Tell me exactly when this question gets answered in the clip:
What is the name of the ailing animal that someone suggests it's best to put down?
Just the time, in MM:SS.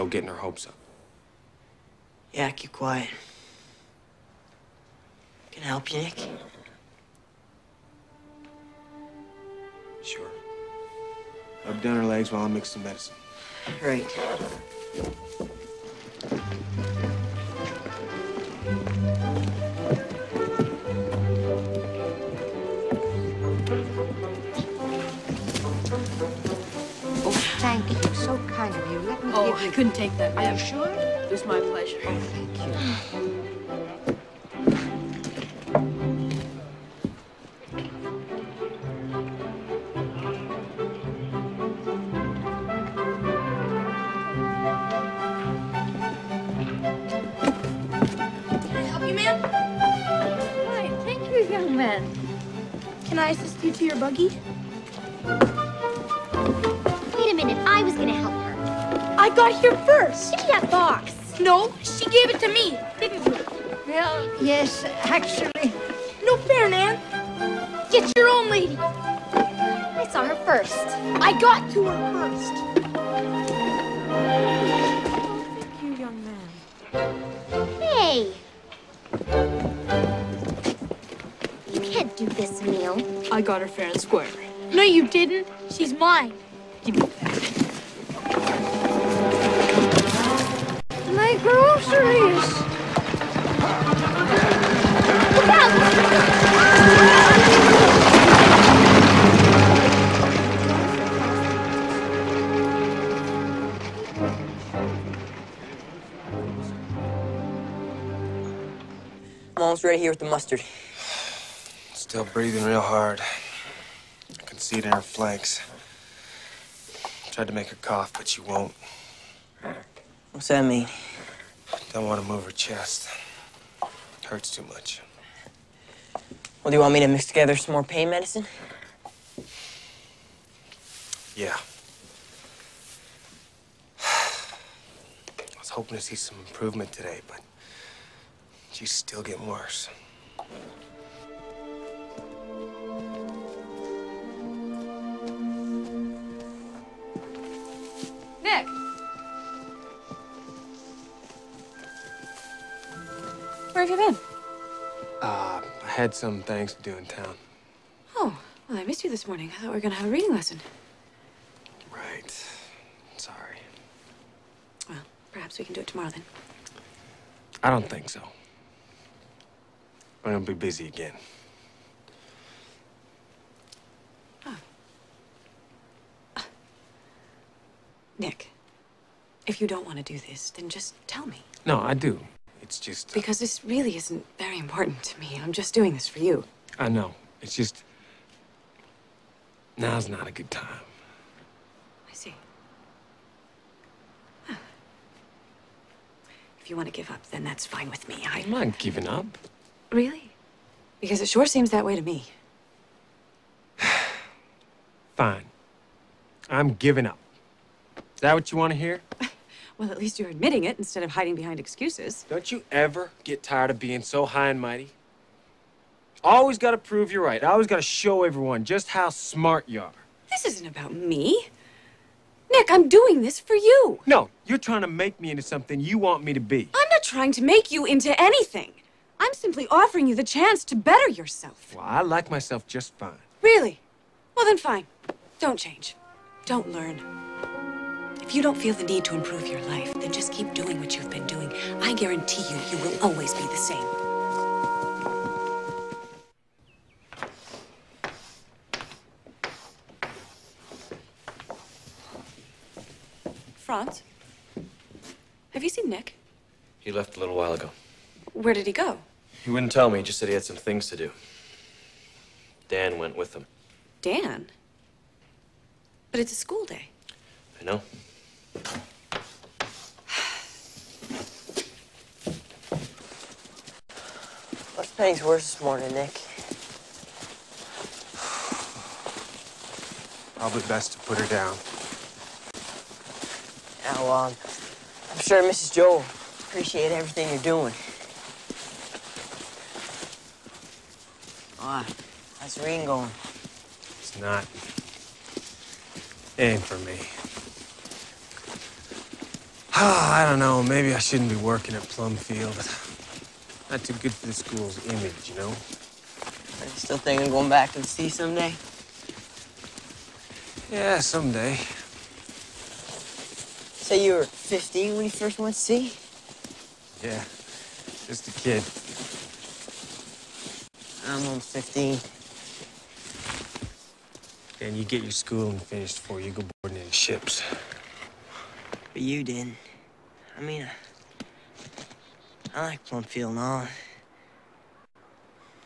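04:34.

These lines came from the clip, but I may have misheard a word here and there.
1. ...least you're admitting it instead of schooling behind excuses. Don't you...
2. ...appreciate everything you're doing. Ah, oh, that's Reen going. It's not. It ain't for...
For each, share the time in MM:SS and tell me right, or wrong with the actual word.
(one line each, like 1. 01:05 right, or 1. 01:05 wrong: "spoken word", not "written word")
1. 03:29 wrong: "hiding", not "schooling"
2. 04:46 right.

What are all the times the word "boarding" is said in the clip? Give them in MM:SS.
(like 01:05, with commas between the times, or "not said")
05:26.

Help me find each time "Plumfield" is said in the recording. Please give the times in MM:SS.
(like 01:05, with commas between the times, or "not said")
05:01, 05:32.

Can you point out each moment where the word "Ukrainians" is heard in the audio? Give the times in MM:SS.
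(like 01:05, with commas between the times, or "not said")
not said.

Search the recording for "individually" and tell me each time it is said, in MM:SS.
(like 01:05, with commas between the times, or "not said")
not said.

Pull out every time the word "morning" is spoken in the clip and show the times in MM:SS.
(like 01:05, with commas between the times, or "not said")
02:39, 04:35.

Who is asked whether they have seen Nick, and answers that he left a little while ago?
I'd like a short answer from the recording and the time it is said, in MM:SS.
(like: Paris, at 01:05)
Franz, at 04:13.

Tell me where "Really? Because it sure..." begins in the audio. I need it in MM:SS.
03:19.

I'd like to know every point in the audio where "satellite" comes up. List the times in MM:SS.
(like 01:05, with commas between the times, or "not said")
not said.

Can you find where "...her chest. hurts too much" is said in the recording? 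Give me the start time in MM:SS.
02:02.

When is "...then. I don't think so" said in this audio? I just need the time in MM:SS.
02:46.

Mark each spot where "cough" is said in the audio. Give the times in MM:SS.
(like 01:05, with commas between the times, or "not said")
01:57.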